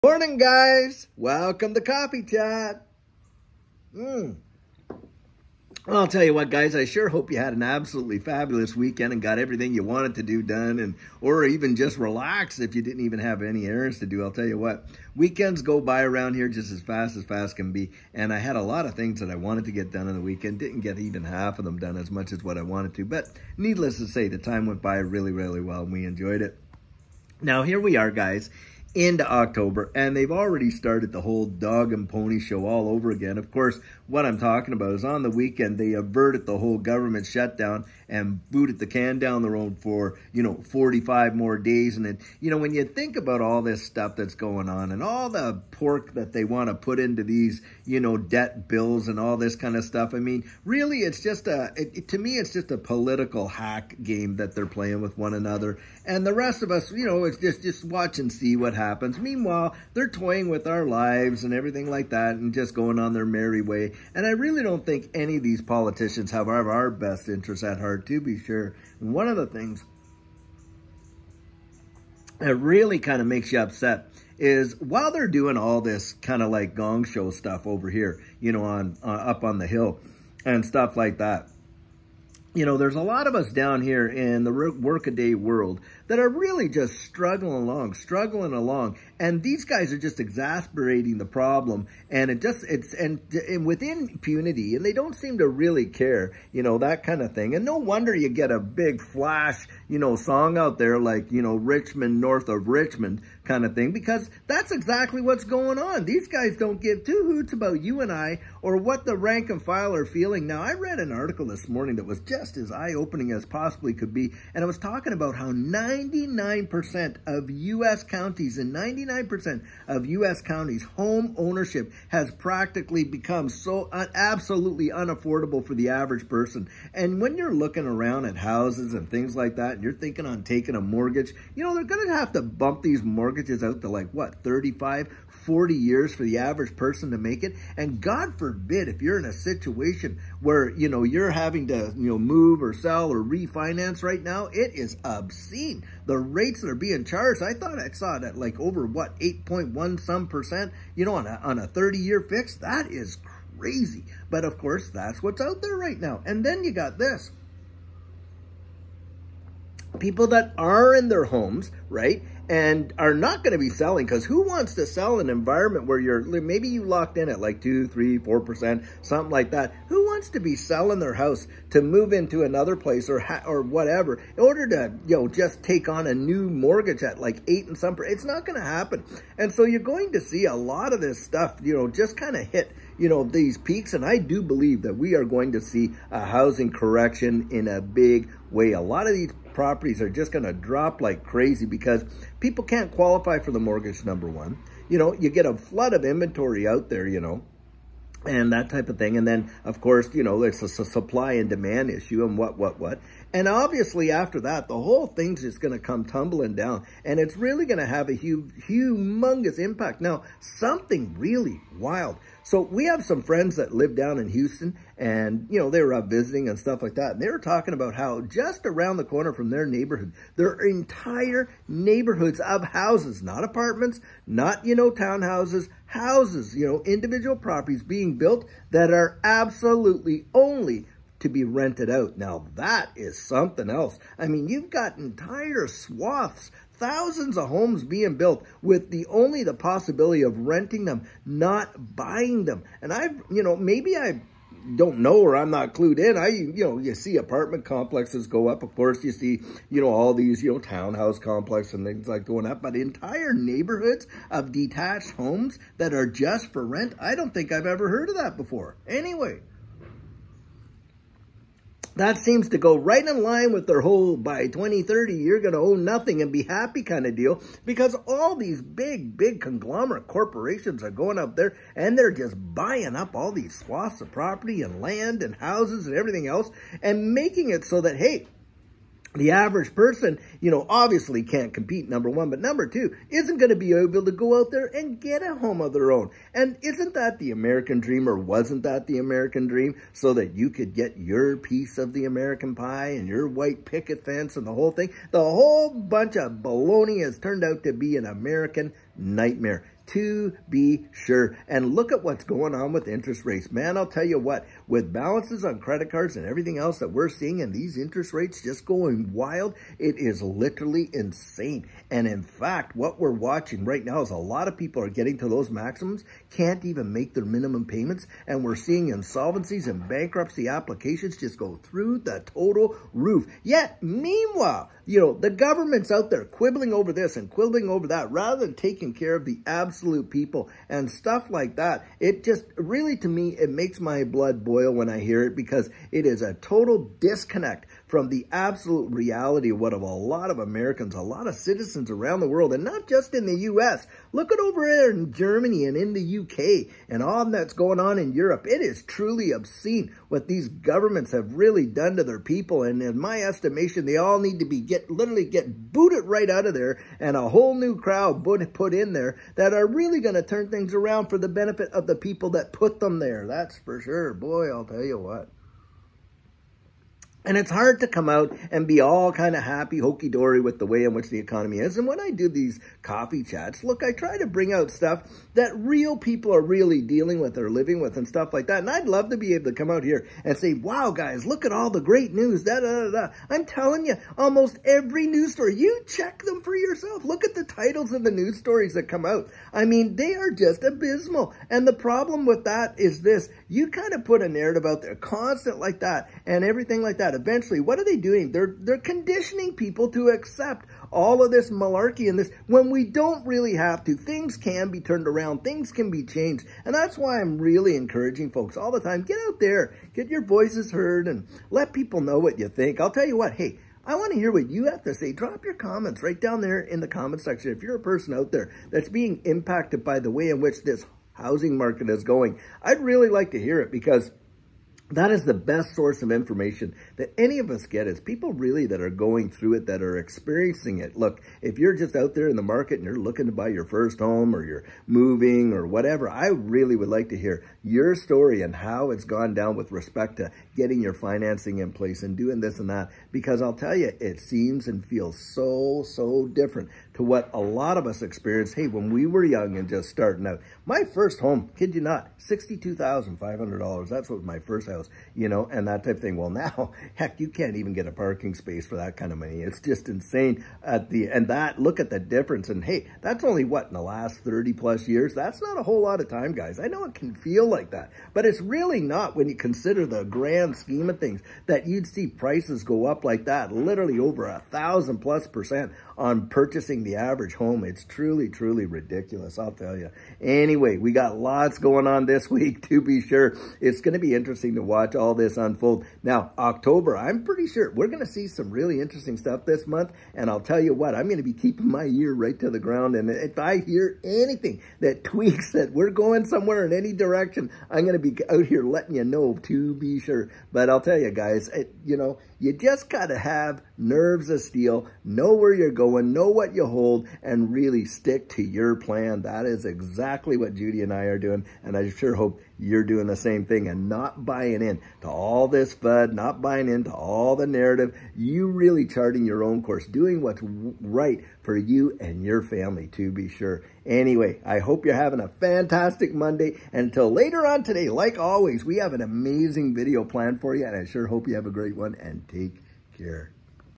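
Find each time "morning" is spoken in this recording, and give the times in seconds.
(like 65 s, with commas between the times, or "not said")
0 s, 111 s.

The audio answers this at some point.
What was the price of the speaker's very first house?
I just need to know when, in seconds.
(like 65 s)
452 s.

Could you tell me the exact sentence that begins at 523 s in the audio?
Anyway, I hope you're having a fantastic Monday.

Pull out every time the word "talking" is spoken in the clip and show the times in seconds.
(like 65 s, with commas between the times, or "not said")
34 s, 114 s, 217 s.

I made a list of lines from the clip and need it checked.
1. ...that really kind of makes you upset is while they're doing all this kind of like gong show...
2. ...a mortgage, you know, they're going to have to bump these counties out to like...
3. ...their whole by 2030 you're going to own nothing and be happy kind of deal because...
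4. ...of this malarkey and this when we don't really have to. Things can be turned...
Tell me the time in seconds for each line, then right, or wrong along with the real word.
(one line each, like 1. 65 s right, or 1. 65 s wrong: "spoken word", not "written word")
1. 72 s right
2. 130 s wrong: "mortgages", not "counties"
3. 263 s right
4. 401 s right.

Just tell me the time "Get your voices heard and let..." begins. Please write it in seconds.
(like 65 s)
409 s.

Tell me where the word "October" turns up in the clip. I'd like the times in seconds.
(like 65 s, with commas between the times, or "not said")
29 s, 486 s.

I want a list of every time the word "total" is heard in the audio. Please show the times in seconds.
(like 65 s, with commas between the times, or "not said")
322 s, 336 s.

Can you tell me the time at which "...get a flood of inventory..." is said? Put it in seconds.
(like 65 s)
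195 s.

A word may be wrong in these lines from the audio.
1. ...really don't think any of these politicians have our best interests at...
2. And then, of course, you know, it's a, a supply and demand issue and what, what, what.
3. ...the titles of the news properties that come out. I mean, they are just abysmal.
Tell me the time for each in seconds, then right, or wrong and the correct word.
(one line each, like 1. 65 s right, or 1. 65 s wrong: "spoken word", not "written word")
1. 64 s right
2. 199 s right
3. 387 s wrong: "stories", not "properties".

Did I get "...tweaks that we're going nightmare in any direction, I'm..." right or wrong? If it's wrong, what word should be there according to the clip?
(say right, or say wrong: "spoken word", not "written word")
wrong: "somewhere", not "nightmare".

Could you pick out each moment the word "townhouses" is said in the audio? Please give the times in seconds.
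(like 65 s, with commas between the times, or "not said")
224 s, 250 s.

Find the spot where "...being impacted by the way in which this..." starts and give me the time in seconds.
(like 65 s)
418 s.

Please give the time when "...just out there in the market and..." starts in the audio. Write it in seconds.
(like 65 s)
431 s.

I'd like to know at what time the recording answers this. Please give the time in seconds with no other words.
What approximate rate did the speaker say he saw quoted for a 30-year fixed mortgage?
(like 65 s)
149 s.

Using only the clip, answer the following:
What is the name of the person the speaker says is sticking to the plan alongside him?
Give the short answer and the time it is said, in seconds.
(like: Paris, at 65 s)
Judy, at 510 s.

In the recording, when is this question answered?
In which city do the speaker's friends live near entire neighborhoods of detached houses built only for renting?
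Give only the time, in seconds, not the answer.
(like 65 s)
214 s.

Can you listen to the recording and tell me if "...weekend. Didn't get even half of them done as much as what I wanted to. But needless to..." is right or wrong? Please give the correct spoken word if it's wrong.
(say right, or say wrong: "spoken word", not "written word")
right.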